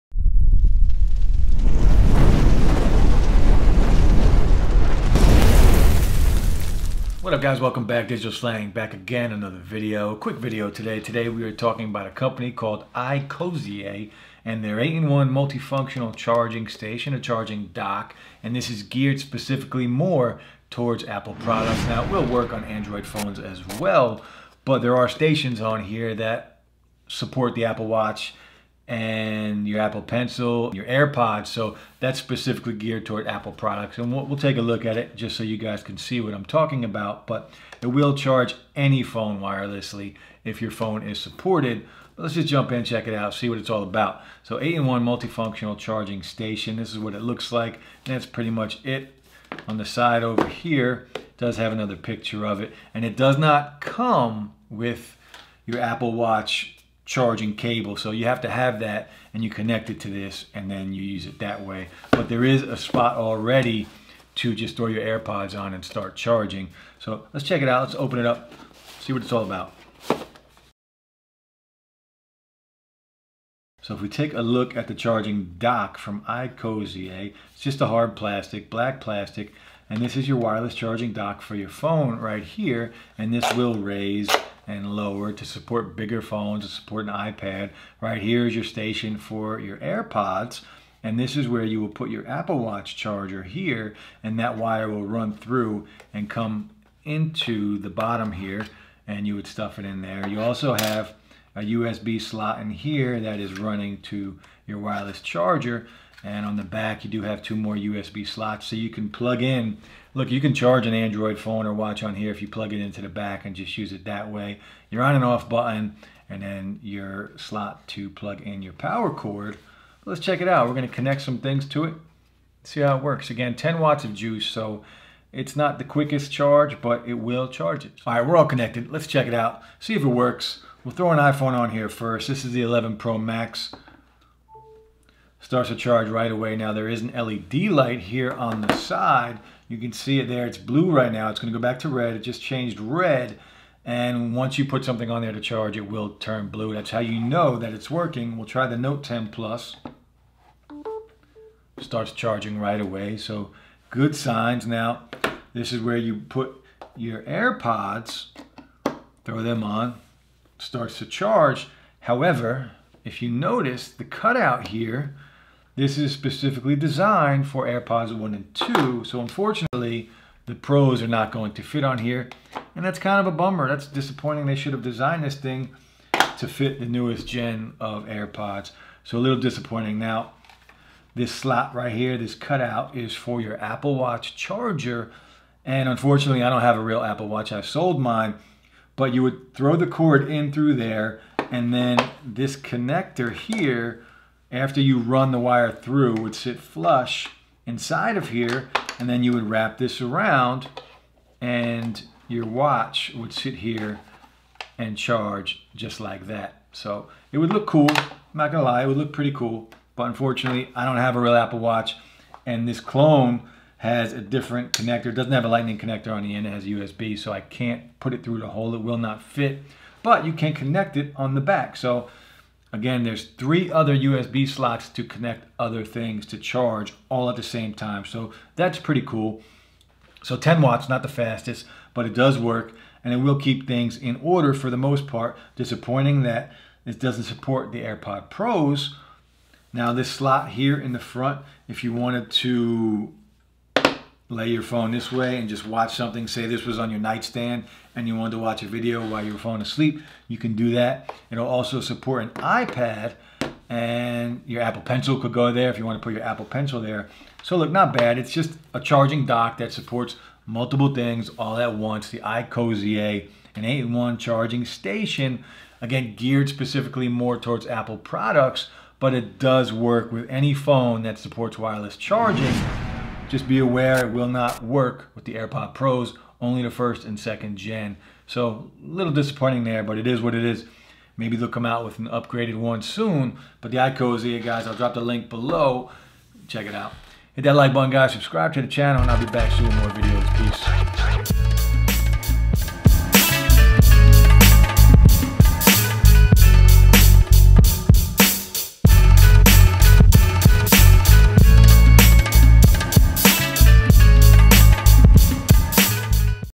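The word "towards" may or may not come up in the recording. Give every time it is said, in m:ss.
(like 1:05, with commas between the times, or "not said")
0:20, 0:33, 4:27.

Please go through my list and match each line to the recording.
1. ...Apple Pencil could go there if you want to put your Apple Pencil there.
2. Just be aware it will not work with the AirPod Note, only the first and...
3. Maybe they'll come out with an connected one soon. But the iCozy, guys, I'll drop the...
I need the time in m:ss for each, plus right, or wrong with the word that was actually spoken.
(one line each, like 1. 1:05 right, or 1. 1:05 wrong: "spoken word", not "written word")
1. 4:14 right
2. 4:33 wrong: "Pros", not "Note"
3. 4:41 wrong: "upgraded", not "connected".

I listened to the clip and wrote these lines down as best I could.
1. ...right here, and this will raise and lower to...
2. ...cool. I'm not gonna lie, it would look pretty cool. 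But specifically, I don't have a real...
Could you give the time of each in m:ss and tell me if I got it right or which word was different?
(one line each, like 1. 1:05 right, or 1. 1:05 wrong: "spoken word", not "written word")
1. 1:22 right
2. 3:27 wrong: "unfortunately", not "specifically".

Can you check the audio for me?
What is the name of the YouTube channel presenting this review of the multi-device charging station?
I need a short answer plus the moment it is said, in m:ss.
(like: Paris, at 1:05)
Digital Slang, at 0:08.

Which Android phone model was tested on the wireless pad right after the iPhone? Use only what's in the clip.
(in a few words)
Note 10 Plus.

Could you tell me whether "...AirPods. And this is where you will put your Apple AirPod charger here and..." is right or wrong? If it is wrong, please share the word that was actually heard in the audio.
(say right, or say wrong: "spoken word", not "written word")
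wrong: "Watch", not "AirPod".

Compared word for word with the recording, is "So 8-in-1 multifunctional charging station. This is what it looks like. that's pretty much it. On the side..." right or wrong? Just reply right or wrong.
right.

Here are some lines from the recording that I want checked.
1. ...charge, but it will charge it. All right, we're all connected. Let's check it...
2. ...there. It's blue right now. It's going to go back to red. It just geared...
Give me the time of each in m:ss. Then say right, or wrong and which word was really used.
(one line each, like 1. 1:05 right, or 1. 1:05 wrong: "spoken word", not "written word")
1. 2:06 right
2. 2:20 wrong: "changed", not "geared".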